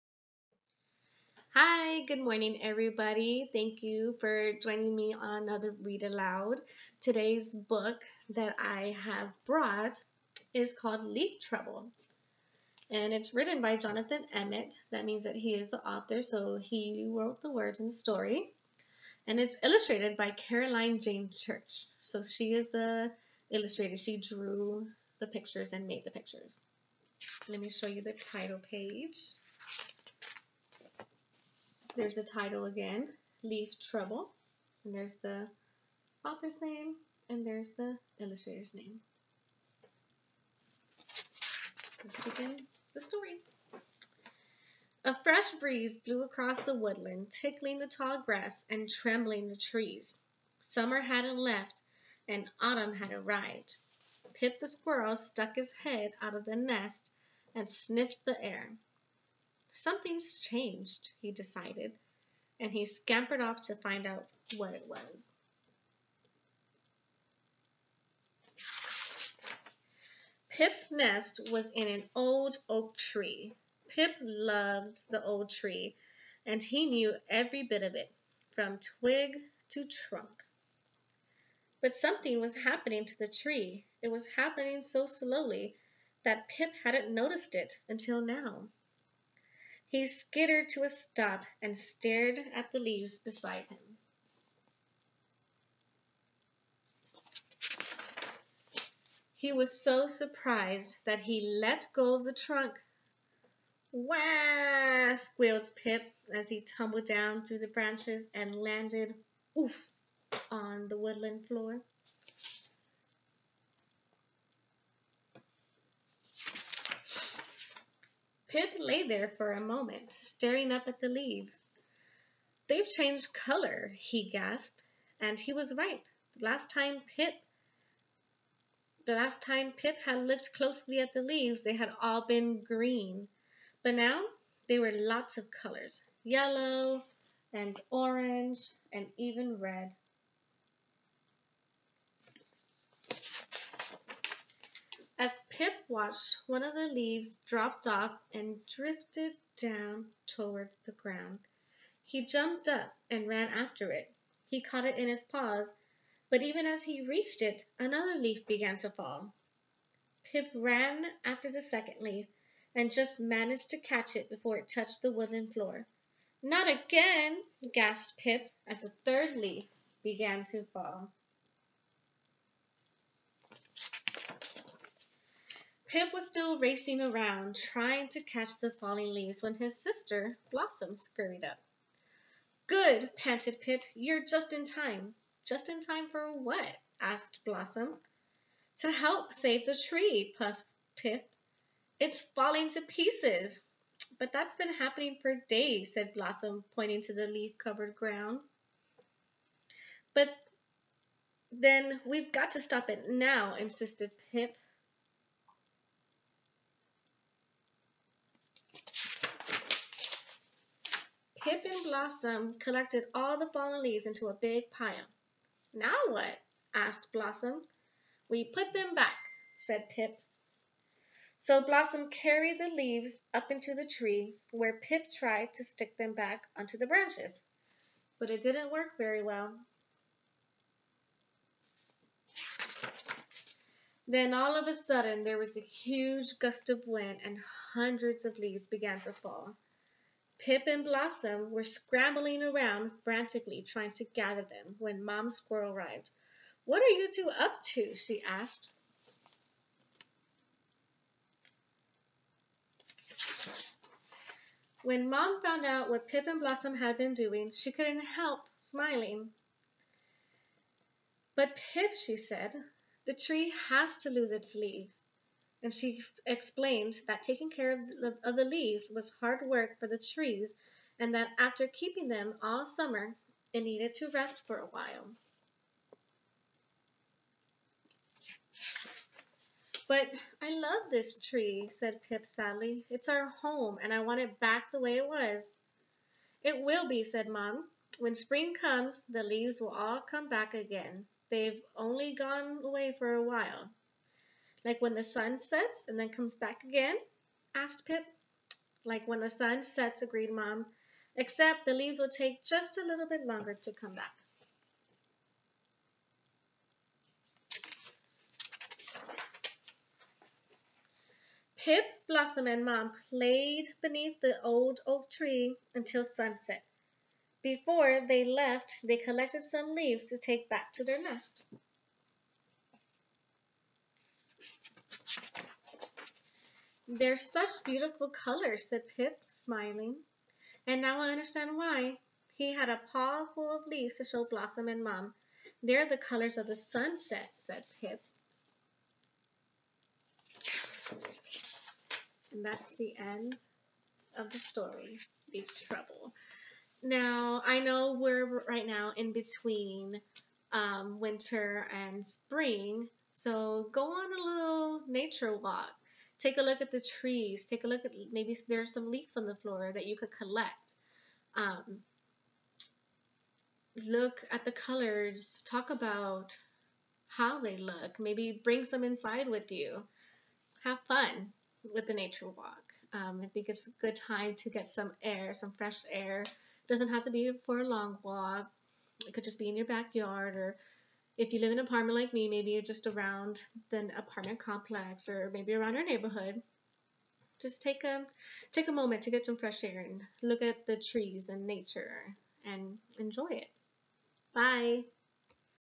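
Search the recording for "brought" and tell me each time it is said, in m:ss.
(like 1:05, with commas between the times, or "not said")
0:09.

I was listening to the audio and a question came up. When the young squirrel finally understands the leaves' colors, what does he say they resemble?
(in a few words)
The sunset.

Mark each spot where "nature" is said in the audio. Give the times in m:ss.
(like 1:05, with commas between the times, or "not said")
5:54, 6:11, 6:31.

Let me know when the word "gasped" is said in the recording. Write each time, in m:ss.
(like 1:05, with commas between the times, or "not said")
2:04, 2:47.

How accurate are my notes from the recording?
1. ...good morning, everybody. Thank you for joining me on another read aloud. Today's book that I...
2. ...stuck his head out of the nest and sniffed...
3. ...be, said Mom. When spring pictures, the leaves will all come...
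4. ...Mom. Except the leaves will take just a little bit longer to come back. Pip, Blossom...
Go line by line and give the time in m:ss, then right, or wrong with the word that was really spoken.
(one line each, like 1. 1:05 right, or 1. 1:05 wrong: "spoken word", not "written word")
1. 0:02 right
2. 0:55 right
3. 4:46 wrong: "comes", not "pictures"
4. 5:00 right.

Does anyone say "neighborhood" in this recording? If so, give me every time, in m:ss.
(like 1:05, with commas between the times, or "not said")
6:25.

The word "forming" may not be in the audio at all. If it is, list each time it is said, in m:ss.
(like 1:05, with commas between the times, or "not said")
not said.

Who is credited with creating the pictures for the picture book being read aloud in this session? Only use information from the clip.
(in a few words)
Caroline Jayne Church.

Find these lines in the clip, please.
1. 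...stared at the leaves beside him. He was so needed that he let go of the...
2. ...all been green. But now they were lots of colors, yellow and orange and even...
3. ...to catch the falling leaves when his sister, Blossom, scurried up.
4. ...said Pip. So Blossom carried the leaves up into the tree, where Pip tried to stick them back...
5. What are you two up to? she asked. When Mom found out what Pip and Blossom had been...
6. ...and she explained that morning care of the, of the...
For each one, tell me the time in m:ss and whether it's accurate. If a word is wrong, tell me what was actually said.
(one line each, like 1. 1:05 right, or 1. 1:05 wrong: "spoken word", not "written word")
1. 1:31 wrong: "surprised", not "needed"
2. 2:12 right
3. 2:58 right
4. 3:39 right
5. 4:06 right
6. 4:25 wrong: "taking", not "morning".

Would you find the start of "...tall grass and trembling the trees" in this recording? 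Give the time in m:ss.
0:47.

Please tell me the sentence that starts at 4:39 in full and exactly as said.
But I love this tree, said Pip sadly.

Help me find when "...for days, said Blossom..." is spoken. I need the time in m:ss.
3:15.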